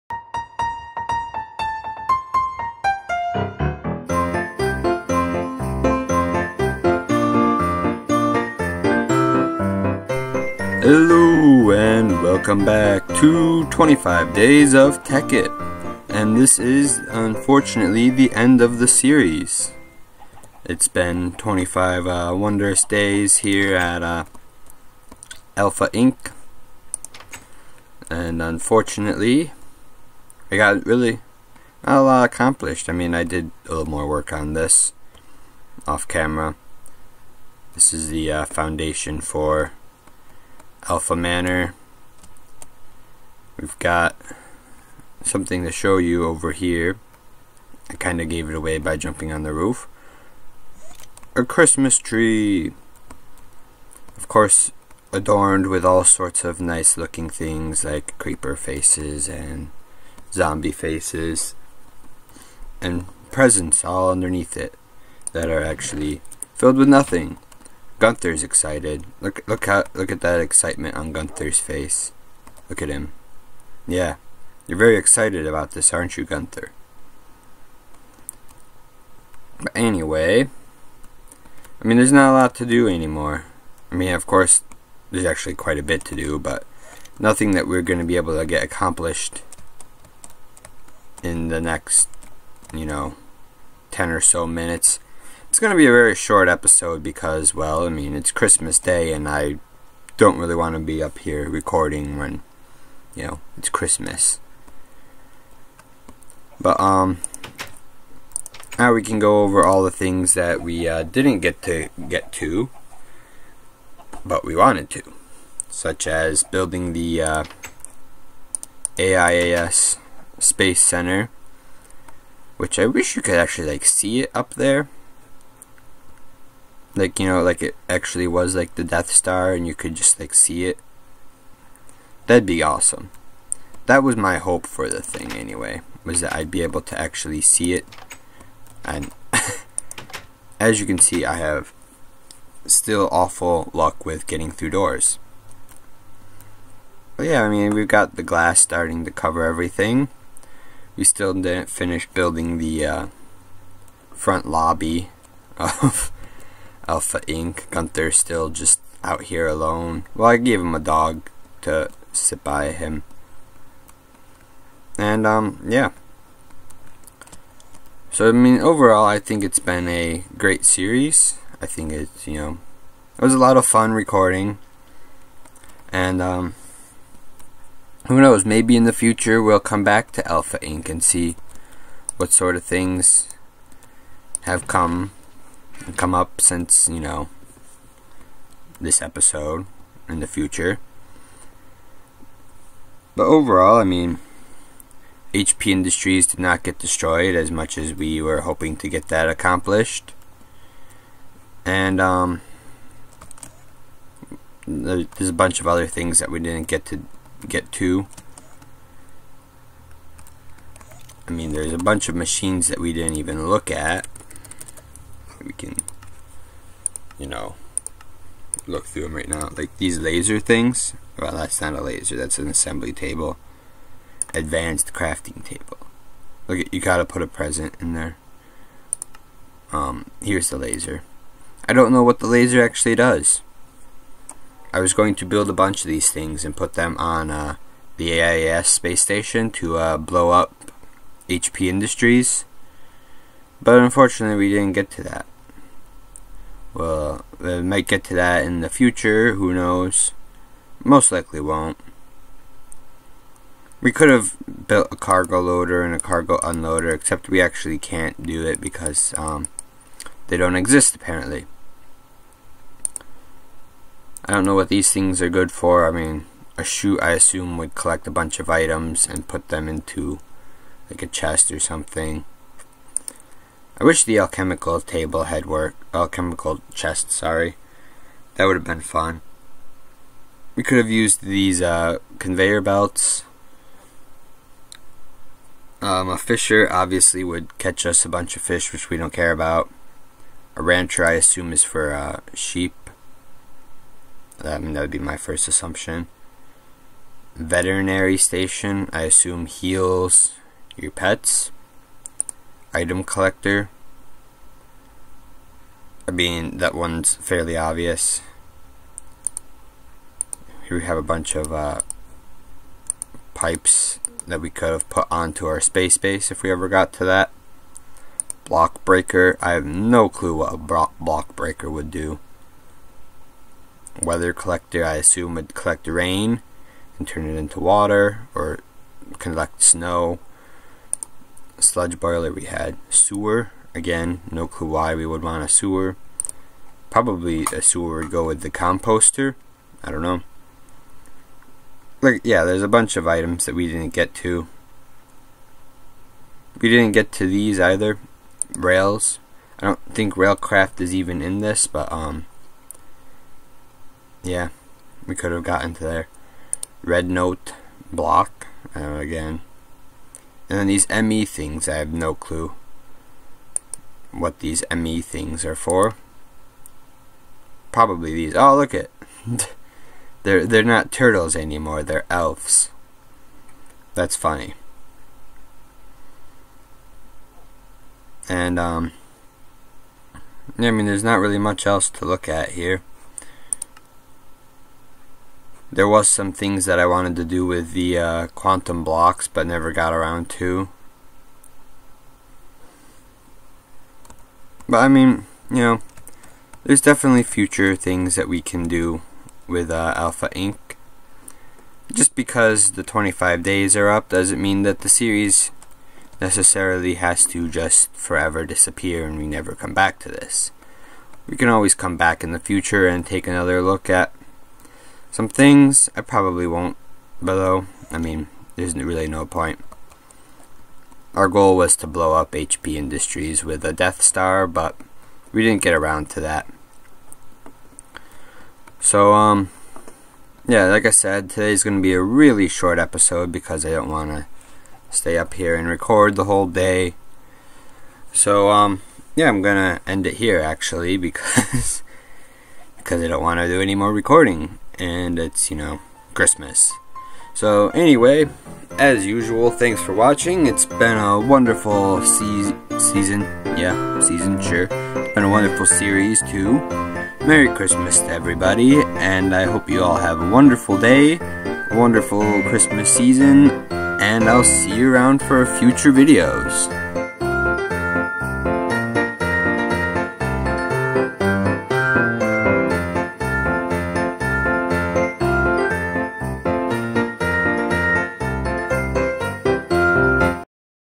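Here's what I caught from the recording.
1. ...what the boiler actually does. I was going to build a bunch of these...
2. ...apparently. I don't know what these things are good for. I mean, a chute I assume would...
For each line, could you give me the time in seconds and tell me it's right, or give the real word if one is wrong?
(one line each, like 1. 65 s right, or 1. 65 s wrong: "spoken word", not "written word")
1. 232 s wrong: "laser", not "boiler"
2. 260 s right.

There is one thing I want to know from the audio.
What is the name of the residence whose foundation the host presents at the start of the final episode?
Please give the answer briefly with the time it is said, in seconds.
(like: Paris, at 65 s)
Alpha Manor, at 40 s.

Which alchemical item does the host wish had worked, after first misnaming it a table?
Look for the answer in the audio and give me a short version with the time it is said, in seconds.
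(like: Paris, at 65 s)
Alchemical chest, at 275 s.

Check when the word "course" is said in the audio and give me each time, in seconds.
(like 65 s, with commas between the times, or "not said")
54 s, 84 s.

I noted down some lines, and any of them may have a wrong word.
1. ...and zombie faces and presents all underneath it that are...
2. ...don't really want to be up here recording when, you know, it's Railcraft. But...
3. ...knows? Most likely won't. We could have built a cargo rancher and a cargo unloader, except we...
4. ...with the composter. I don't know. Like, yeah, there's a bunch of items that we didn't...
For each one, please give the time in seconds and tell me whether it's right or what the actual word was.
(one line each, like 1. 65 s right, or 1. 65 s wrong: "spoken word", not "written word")
1. 59 s right
2. 100 s wrong: "Christmas", not "Railcraft"
3. 249 s wrong: "loader", not "rancher"
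4. 338 s right.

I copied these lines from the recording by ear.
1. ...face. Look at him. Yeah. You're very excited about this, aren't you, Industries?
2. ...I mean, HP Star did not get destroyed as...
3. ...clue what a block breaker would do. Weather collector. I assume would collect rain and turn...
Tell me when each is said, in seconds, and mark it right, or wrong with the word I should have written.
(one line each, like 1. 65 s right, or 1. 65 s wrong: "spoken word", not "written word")
1. 71 s wrong: "Gunther", not "Industries"
2. 193 s wrong: "Industries", not "Star"
3. 320 s right.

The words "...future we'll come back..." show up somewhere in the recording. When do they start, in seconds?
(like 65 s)
178 s.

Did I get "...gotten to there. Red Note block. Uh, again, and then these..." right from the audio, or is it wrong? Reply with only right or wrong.
right.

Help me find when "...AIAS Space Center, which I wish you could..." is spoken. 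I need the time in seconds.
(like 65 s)
118 s.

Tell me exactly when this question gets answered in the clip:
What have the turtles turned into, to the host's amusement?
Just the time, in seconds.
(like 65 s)
372 s.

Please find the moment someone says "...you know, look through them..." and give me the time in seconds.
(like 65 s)
217 s.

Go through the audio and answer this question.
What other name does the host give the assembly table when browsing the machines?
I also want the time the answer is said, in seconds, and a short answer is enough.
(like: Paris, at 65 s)
Advanced crafting table, at 224 s.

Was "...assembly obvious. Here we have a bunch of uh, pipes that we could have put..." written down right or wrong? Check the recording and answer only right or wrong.
wrong.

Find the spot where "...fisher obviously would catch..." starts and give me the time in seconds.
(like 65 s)
286 s.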